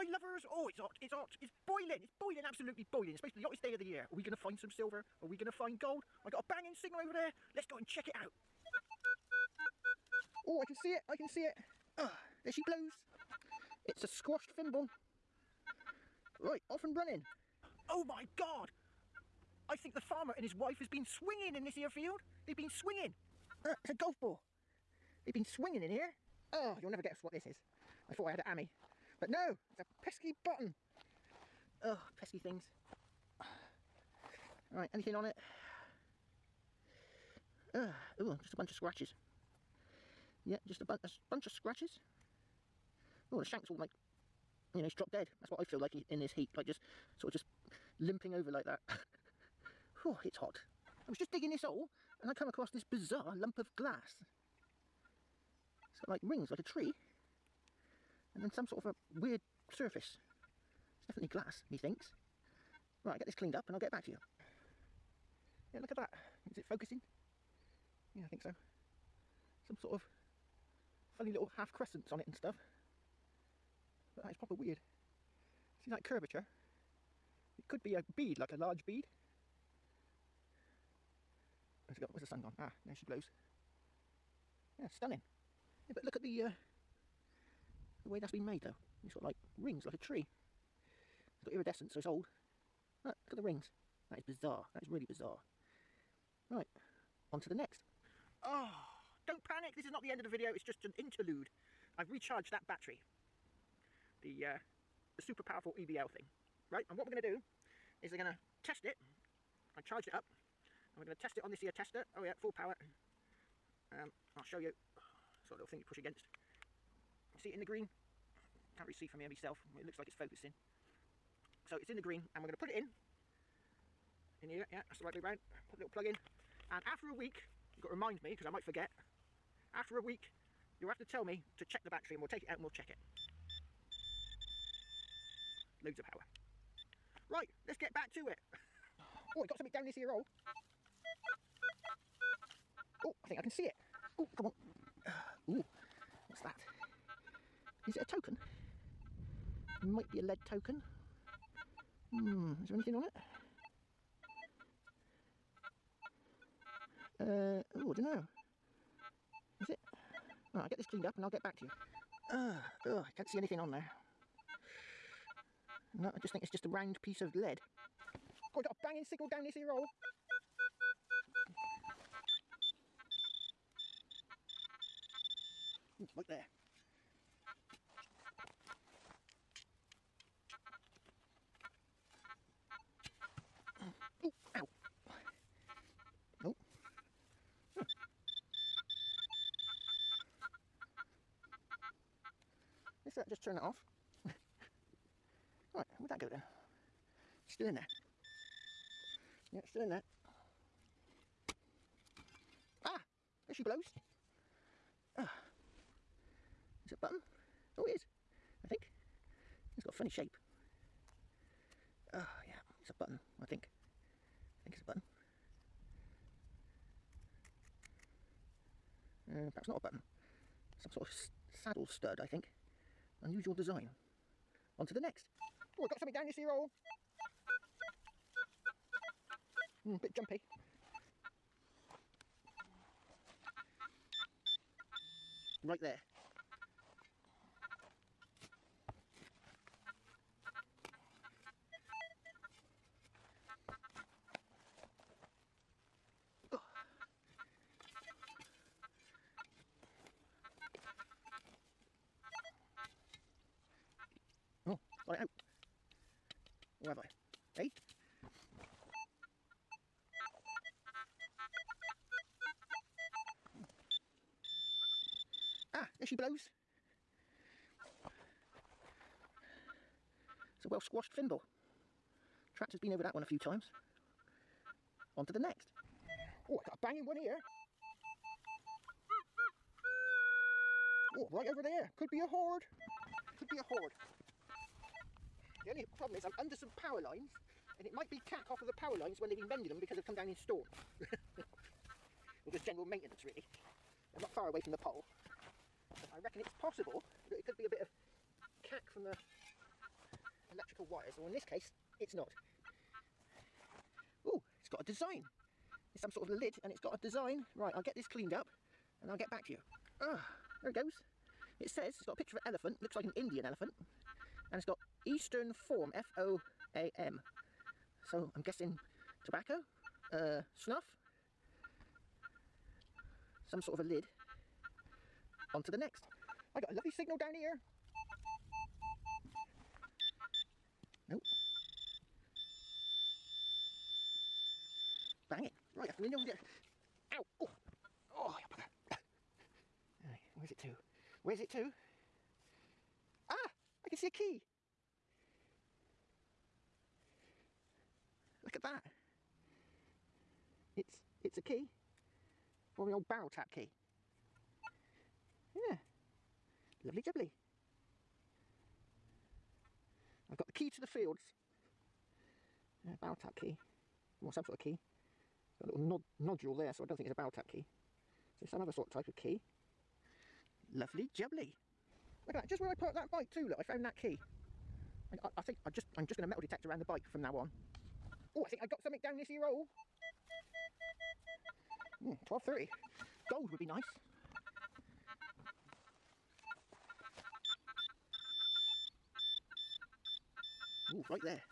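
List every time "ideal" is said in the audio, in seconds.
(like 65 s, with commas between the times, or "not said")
not said.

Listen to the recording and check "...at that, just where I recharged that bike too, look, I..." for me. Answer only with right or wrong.
wrong.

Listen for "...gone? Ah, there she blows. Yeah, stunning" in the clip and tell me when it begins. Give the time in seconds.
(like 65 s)
82 s.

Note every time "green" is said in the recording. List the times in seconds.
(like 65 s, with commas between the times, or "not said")
117 s, 122 s.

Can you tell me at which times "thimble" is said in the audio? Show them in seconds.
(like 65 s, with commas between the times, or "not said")
14 s, 271 s.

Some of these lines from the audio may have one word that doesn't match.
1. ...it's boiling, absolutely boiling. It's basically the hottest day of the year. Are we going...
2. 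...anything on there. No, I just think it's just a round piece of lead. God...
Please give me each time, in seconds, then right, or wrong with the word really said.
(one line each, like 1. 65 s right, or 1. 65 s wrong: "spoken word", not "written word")
1. 2 s right
2. 163 s right.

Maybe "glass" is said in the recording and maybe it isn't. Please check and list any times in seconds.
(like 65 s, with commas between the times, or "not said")
53 s, 61 s.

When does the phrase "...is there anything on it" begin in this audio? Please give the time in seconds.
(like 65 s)
152 s.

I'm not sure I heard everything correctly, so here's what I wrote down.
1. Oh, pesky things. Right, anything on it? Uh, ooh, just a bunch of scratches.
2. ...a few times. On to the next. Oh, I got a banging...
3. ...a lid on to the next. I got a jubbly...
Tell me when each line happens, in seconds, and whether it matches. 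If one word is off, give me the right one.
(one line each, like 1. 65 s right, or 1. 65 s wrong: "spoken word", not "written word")
1. 31 s right
2. 273 s right
3. 323 s wrong: "lovely", not "jubbly".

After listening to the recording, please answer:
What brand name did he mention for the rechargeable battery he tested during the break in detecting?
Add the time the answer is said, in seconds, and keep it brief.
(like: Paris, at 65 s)
EBL, at 105 s.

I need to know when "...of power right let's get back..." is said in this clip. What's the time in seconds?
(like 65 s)
135 s.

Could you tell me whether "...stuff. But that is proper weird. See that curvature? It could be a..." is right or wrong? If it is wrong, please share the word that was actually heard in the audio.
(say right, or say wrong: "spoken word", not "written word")
right.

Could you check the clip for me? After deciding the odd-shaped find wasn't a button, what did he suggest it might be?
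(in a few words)
Saddle stud.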